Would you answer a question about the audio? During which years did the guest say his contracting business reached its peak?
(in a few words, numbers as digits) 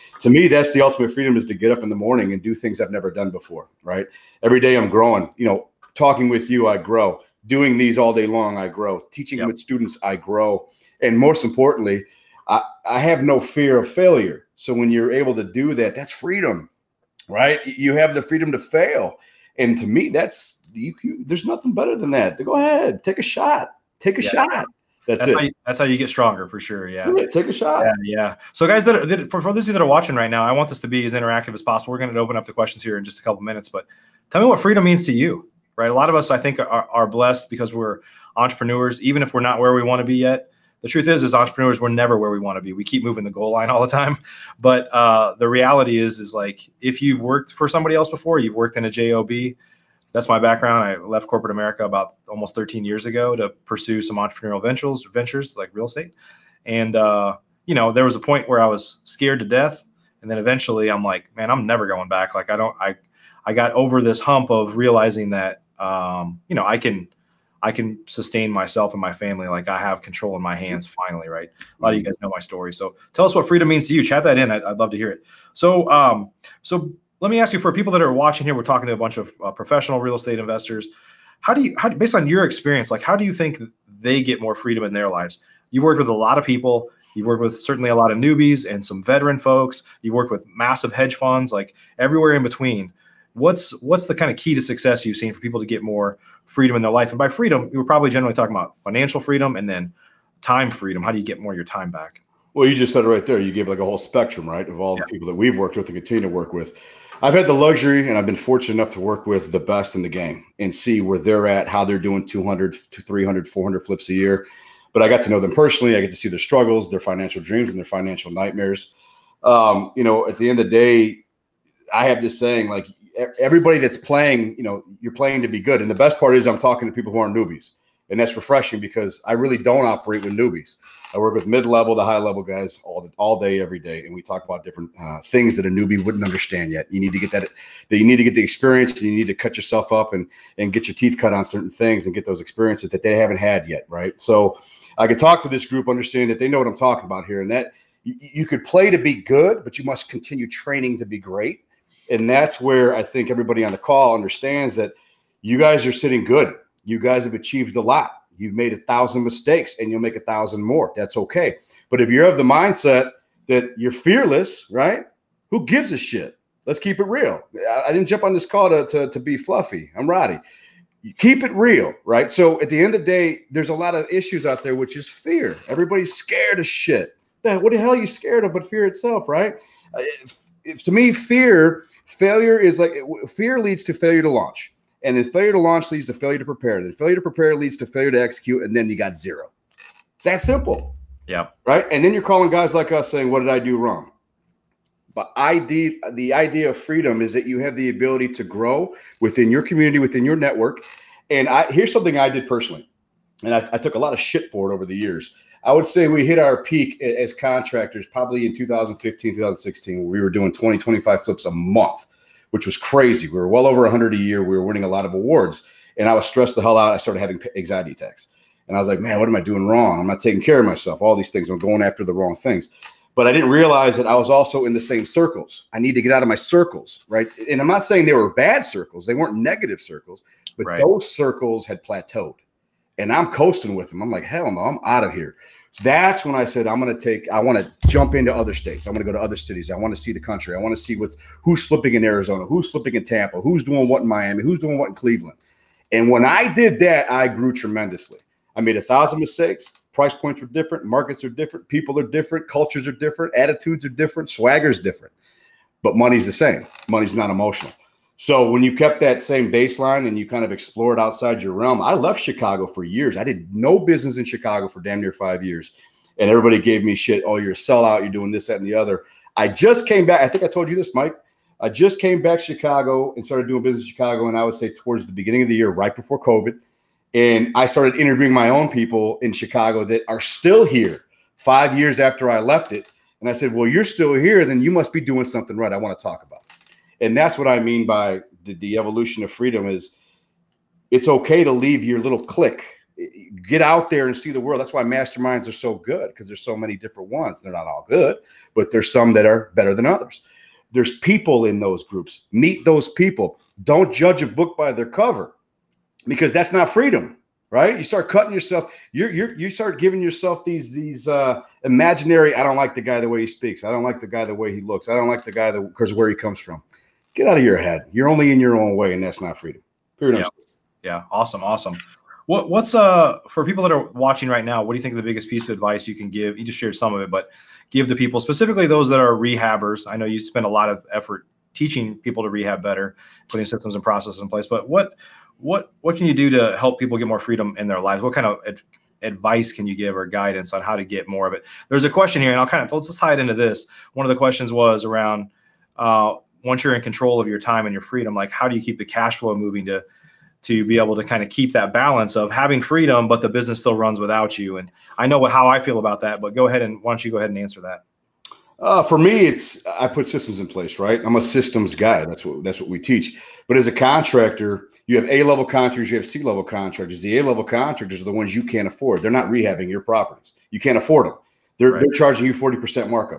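2015, 2016.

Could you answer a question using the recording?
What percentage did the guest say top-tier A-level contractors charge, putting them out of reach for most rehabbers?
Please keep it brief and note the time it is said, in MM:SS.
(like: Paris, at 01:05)
40%, at 06:12.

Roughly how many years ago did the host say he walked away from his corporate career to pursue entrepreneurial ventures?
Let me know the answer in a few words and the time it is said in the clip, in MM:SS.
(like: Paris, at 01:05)
13, at 00:52.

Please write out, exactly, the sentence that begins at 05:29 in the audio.
I know you spend a lot of effort teaching people to rehab better, putting systems and processes in place.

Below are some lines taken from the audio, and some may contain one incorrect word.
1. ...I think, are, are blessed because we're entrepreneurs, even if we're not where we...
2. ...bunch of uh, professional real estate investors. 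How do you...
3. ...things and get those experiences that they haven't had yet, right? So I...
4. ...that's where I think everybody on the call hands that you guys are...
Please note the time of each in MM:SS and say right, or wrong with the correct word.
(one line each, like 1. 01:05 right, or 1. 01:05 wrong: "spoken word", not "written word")
1. 00:36 right
2. 01:18 right
3. 02:21 right
4. 02:32 wrong: "understands", not "hands".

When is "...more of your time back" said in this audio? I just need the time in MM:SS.
01:41.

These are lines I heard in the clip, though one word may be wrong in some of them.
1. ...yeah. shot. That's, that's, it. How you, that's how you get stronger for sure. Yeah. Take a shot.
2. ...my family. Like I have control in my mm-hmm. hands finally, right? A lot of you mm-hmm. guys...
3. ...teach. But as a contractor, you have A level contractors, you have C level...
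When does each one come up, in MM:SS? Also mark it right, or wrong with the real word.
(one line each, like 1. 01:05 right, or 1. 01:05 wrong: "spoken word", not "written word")
1. 00:24 right
2. 01:09 right
3. 06:02 right.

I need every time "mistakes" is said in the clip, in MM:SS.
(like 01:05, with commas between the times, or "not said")
02:39, 04:09.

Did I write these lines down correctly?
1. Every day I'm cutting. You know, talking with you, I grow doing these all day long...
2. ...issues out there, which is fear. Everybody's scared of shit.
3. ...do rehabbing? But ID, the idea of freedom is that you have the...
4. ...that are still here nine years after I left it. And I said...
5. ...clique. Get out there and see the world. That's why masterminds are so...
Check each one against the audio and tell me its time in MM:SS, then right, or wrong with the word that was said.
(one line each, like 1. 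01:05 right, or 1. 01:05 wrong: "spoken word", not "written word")
1. 00:04 wrong: "growing", not "cutting"
2. 02:54 right
3. 03:13 wrong: "wrong", not "rehabbing"
4. 04:39 wrong: "five", not "nine"
5. 04:52 right.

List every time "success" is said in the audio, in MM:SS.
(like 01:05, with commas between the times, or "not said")
01:34.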